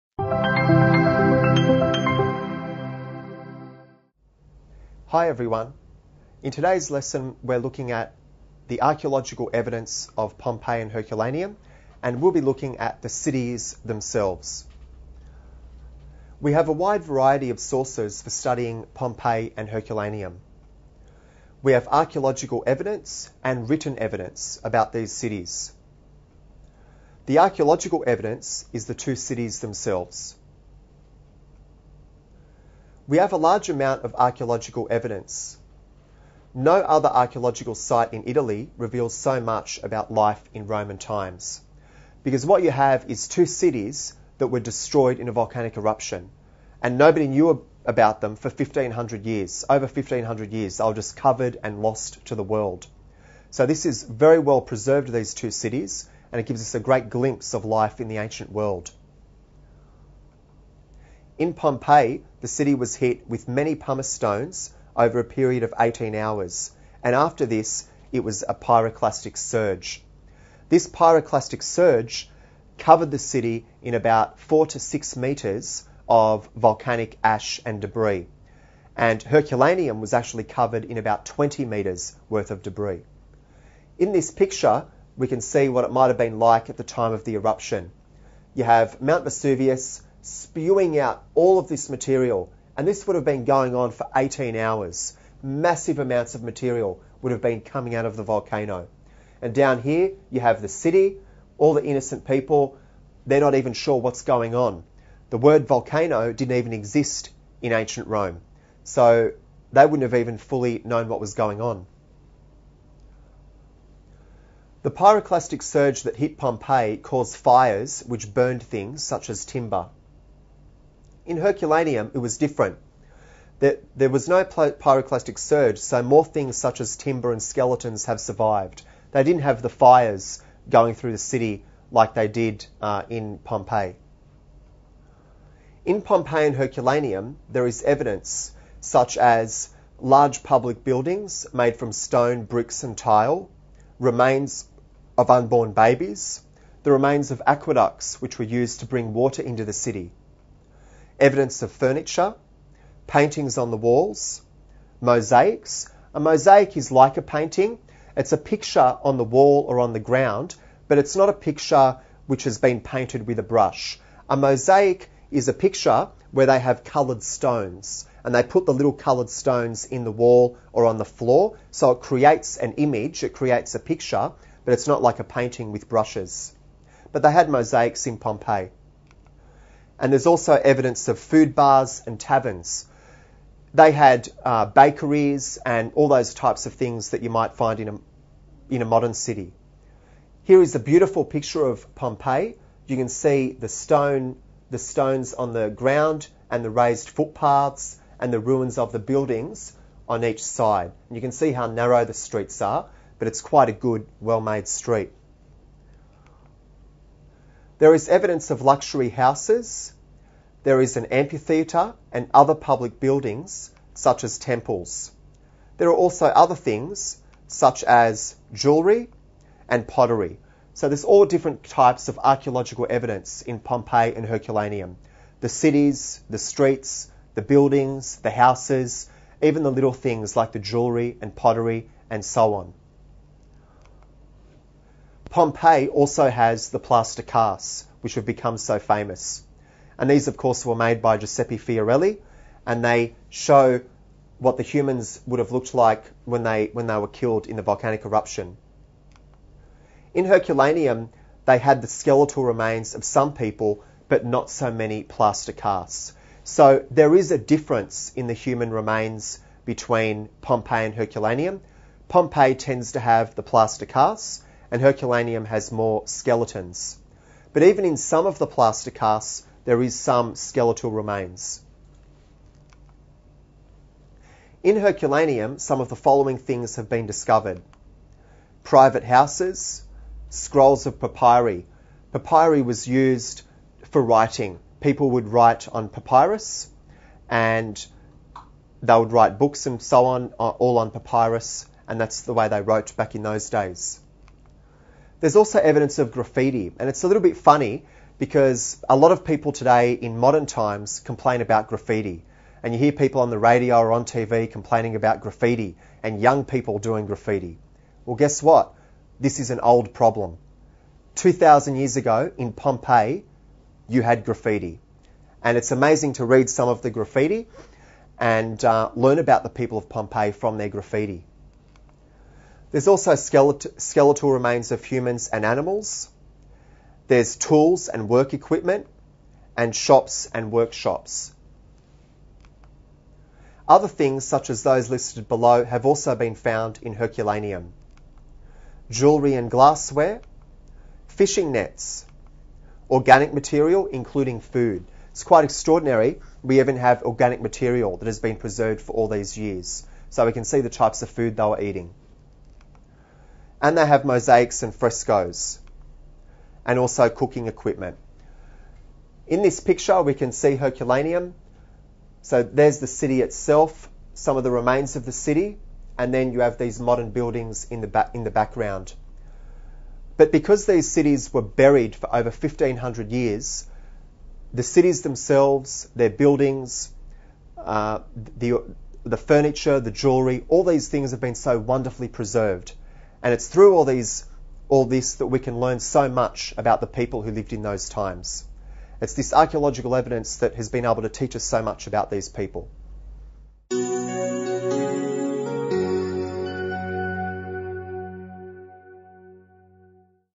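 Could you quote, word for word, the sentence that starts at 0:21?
We have archaeological evidence and written evidence about these cities.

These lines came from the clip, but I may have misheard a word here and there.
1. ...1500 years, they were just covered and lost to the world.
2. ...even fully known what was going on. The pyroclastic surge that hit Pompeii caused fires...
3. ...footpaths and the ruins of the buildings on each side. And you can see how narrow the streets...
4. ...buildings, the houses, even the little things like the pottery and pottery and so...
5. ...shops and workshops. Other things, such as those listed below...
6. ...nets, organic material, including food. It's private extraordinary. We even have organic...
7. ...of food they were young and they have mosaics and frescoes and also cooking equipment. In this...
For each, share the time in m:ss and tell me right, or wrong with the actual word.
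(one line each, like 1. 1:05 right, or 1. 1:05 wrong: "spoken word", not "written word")
1. 0:49 right
2. 1:50 right
3. 3:17 right
4. 3:47 wrong: "jewellery", not "pottery"
5. 5:29 right
6. 5:41 wrong: "quite", not "private"
7. 5:51 wrong: "eating", not "young".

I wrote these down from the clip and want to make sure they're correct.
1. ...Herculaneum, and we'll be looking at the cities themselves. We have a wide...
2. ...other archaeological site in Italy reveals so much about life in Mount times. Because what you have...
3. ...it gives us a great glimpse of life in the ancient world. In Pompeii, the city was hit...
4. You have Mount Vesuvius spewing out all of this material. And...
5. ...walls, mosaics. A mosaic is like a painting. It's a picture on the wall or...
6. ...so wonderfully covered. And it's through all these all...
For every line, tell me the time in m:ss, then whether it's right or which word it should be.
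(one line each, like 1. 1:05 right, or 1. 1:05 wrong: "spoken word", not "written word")
1. 0:10 right
2. 0:36 wrong: "Roman", not "Mount"
3. 0:56 right
4. 1:28 right
5. 2:33 right
6. 6:21 wrong: "preserved", not "covered".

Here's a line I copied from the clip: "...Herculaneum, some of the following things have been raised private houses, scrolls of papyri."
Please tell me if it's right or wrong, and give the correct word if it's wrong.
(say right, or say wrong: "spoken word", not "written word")
wrong: "discovered", not "raised".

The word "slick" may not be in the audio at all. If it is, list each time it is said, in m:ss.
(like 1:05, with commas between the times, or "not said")
not said.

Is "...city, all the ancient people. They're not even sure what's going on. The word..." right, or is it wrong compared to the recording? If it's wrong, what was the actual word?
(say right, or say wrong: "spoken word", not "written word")
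wrong: "innocent", not "ancient".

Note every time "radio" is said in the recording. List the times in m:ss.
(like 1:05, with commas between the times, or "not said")
5:03.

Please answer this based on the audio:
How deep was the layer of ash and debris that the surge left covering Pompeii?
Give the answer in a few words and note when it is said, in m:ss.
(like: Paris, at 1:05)
4 to 6 meters, at 1:14.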